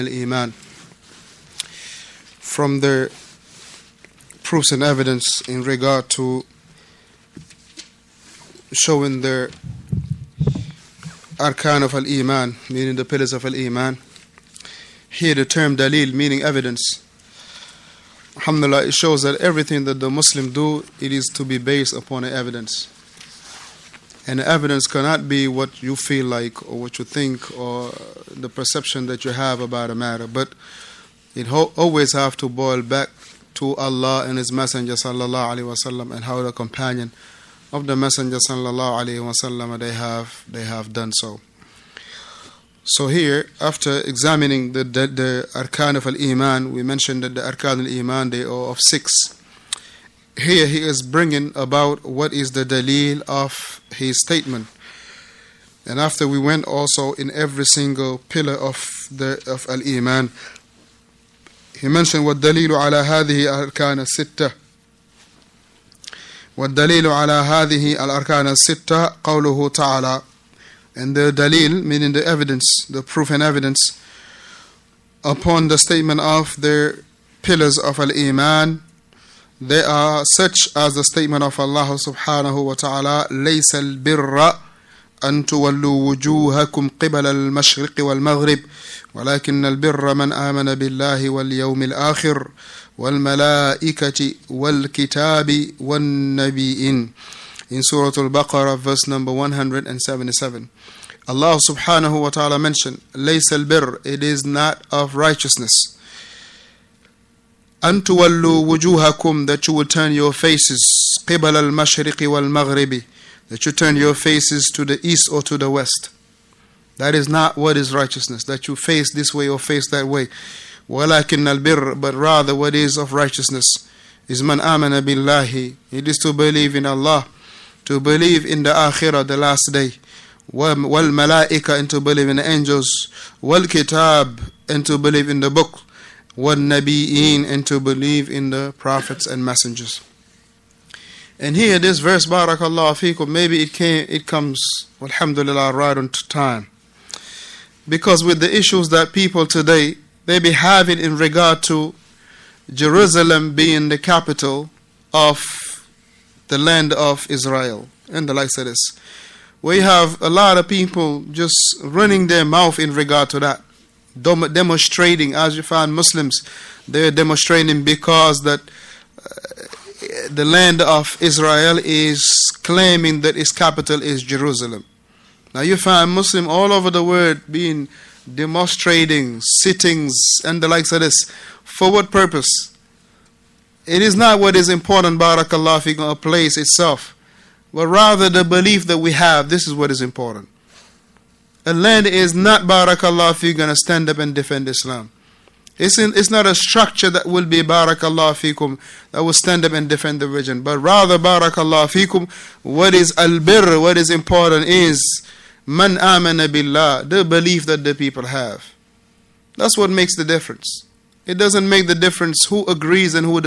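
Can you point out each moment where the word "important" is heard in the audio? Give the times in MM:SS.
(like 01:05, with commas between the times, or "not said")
03:04, 03:10, 03:24.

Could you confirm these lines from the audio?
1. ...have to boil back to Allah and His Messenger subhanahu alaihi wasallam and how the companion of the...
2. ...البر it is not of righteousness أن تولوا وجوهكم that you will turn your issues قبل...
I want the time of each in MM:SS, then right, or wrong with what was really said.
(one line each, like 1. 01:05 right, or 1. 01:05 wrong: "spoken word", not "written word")
1. 00:32 wrong: "sallallahu", not "subhanahu"
2. 01:43 wrong: "faces", not "issues".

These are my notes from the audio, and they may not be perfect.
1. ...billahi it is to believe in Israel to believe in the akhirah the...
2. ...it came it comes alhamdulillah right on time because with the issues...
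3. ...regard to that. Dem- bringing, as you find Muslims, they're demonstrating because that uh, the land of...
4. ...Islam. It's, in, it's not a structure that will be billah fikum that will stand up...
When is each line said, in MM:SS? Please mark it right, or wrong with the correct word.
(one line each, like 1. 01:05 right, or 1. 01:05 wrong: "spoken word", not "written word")
1. 02:04 wrong: "Allah", not "Israel"
2. 02:23 right
3. 02:42 wrong: "demonstrating", not "bringing"
4. 03:14 wrong: "barakallah", not "billah".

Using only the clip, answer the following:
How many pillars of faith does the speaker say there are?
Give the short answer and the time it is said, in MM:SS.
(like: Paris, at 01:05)
6, at 00:48.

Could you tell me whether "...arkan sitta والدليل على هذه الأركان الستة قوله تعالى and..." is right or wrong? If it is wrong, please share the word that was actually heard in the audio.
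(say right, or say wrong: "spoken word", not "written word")
right.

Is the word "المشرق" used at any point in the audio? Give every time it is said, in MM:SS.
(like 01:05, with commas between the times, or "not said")
01:27, 01:51.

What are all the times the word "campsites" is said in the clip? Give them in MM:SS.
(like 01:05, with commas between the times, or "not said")
not said.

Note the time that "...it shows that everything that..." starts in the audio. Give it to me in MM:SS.
00:18.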